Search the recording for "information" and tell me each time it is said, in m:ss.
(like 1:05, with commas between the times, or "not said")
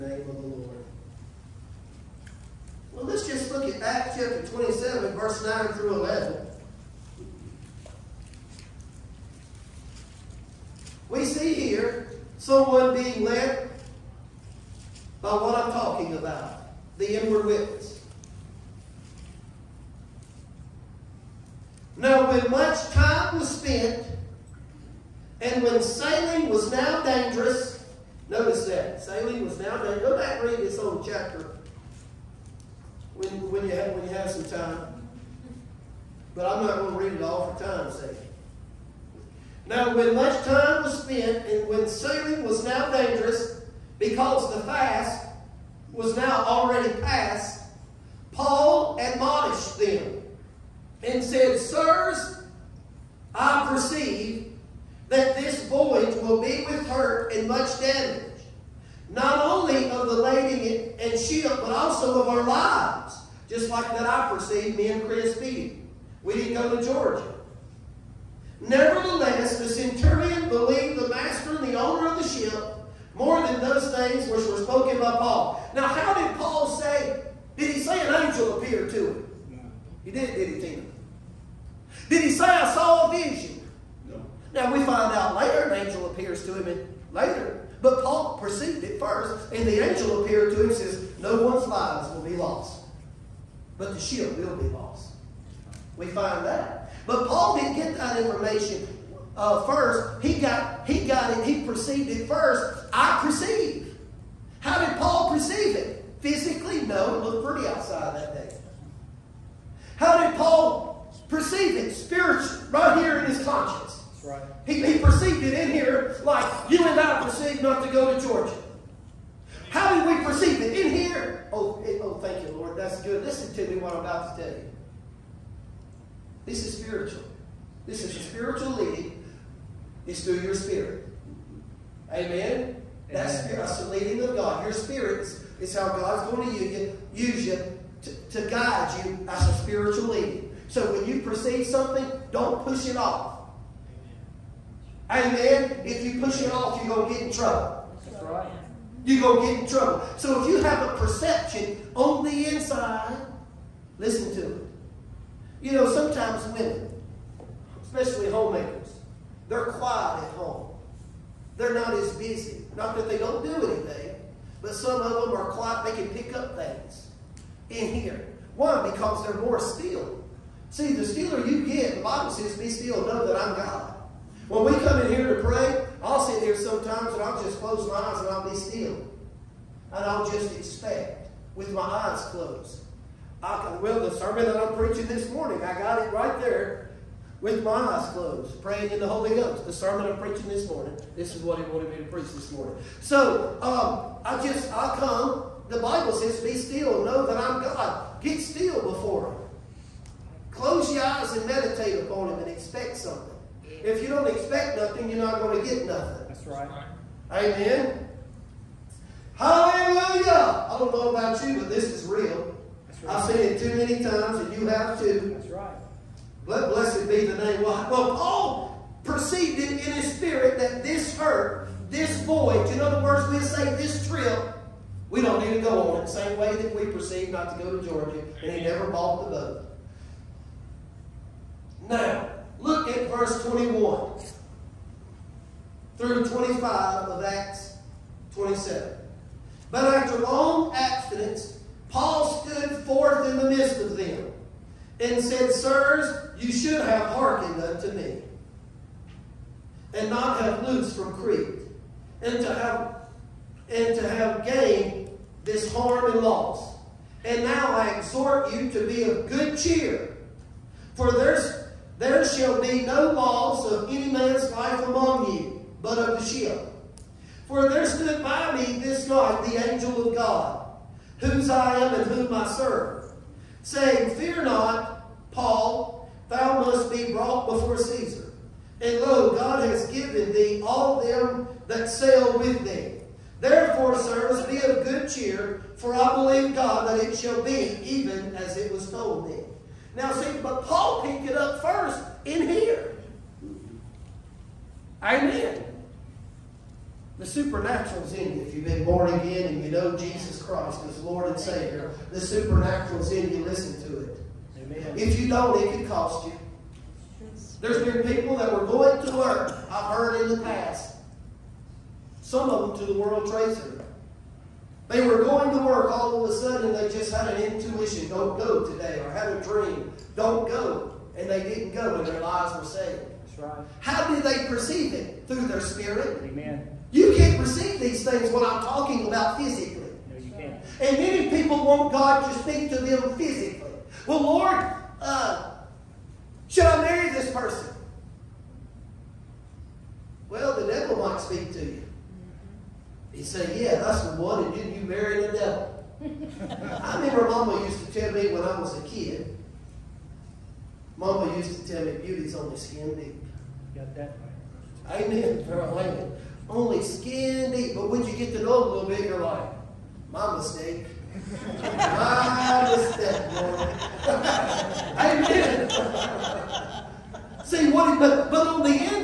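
1:38.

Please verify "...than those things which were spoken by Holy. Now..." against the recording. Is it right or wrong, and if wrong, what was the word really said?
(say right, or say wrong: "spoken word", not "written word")
wrong: "Paul", not "Holy".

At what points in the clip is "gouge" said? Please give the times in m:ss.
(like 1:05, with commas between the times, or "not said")
not said.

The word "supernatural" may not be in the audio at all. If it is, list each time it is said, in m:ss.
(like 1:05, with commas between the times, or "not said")
4:57, 5:02.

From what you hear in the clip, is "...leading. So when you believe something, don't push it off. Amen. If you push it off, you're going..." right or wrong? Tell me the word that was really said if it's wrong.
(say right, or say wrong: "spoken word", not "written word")
wrong: "perceive", not "believe".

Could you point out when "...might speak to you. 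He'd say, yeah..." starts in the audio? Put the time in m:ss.
5:41.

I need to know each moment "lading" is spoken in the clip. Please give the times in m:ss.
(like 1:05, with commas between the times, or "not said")
1:00.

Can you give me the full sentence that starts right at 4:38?
And lo, God has given thee all them that sail with thee.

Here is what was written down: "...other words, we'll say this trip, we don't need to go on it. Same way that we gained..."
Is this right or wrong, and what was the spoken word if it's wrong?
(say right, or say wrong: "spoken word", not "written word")
wrong: "perceived", not "gained".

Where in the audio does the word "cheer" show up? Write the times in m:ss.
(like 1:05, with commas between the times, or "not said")
4:19, 4:45.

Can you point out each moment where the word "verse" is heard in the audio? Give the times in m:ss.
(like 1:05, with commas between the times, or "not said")
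0:05, 3:53.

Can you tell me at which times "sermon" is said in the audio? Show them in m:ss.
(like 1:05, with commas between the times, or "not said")
3:04, 3:09.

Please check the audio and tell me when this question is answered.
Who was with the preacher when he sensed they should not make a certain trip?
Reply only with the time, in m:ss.
1:05.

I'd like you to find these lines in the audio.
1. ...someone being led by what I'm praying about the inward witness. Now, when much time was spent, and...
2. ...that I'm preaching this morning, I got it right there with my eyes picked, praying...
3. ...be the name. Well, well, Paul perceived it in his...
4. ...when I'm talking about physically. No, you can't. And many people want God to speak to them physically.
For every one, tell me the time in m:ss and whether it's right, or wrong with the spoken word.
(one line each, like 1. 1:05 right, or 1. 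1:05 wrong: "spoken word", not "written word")
1. 0:12 wrong: "talking", not "praying"
2. 3:04 wrong: "closed", not "picked"
3. 3:37 right
4. 5:28 right.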